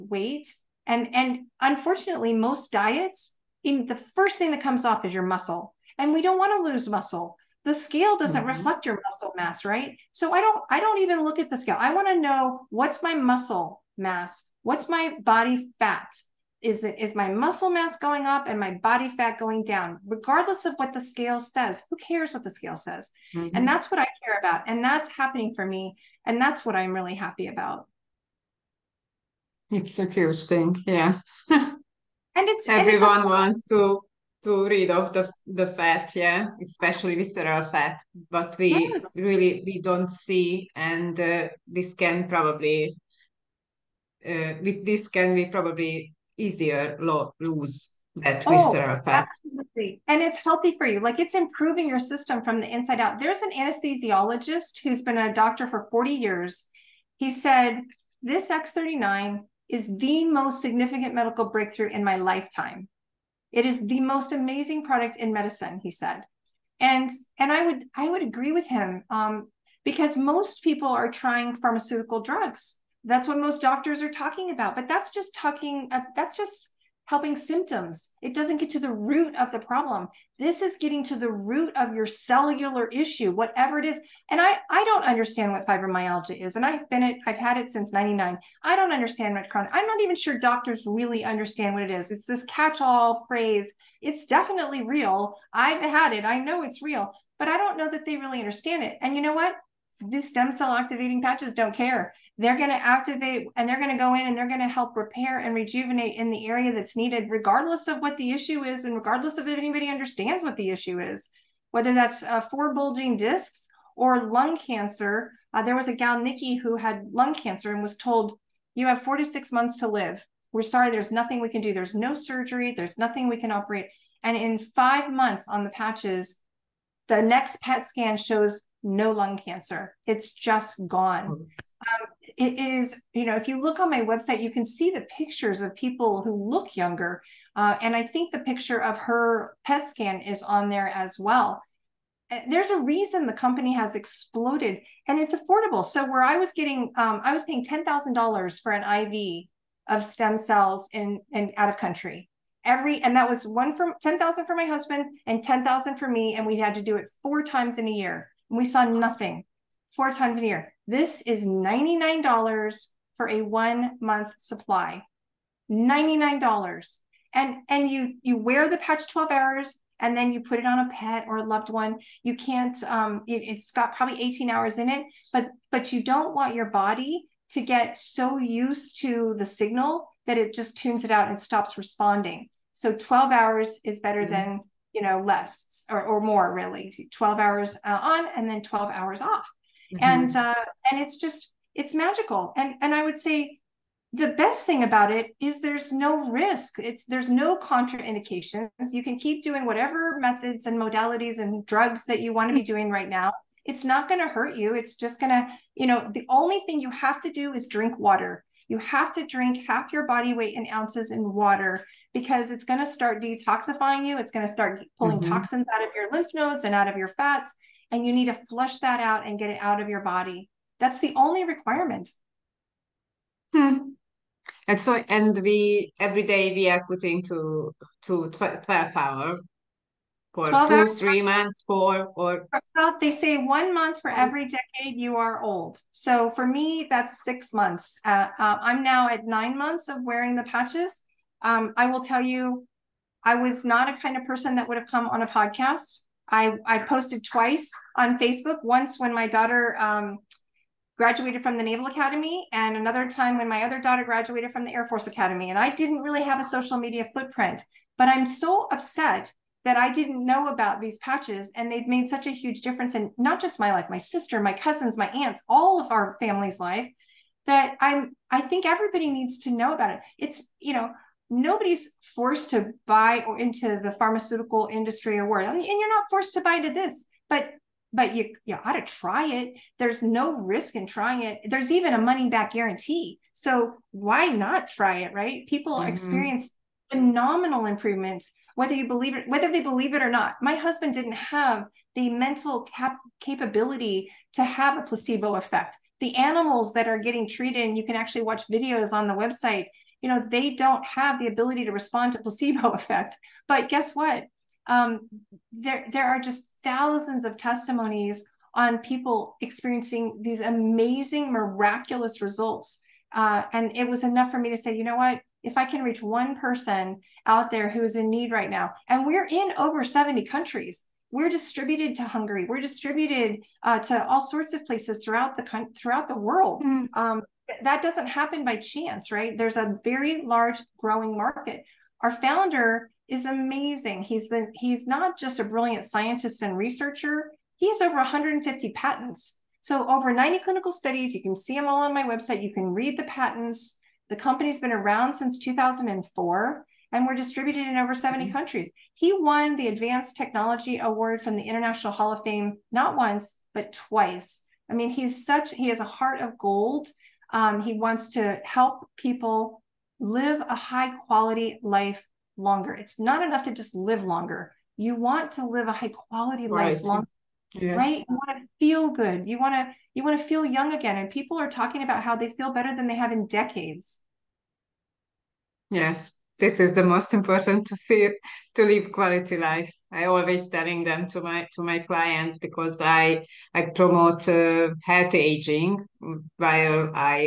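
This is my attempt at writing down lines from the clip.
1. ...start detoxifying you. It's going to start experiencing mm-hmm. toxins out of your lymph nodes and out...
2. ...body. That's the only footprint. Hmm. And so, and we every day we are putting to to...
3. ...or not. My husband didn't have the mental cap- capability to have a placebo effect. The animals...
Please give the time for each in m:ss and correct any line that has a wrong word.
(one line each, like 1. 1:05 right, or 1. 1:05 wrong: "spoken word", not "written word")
1. 3:32 wrong: "pulling", not "experiencing"
2. 3:39 wrong: "requirement", not "footprint"
3. 4:50 right.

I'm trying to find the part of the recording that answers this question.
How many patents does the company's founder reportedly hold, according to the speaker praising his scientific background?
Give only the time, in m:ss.
5:37.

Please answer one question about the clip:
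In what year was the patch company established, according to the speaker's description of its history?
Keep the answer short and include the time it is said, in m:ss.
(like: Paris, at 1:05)
2004, at 5:45.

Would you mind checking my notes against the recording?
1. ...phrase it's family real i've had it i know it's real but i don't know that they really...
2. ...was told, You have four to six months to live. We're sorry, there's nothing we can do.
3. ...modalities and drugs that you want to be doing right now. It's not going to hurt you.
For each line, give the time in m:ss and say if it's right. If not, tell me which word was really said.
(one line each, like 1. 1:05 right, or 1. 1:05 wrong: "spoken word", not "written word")
1. 1:33 wrong: "definitely", not "family"
2. 1:57 right
3. 3:20 right.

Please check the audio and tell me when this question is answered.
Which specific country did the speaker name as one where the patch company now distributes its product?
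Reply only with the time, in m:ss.
5:22.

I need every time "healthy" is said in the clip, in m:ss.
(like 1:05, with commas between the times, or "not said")
0:50, 6:24.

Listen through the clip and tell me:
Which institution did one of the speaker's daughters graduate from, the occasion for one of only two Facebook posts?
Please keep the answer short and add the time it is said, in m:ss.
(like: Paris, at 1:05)
Naval Academy, at 4:11.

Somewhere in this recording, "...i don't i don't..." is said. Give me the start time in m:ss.
0:10.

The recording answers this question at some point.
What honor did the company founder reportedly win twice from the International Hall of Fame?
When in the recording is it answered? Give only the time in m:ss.
5:49.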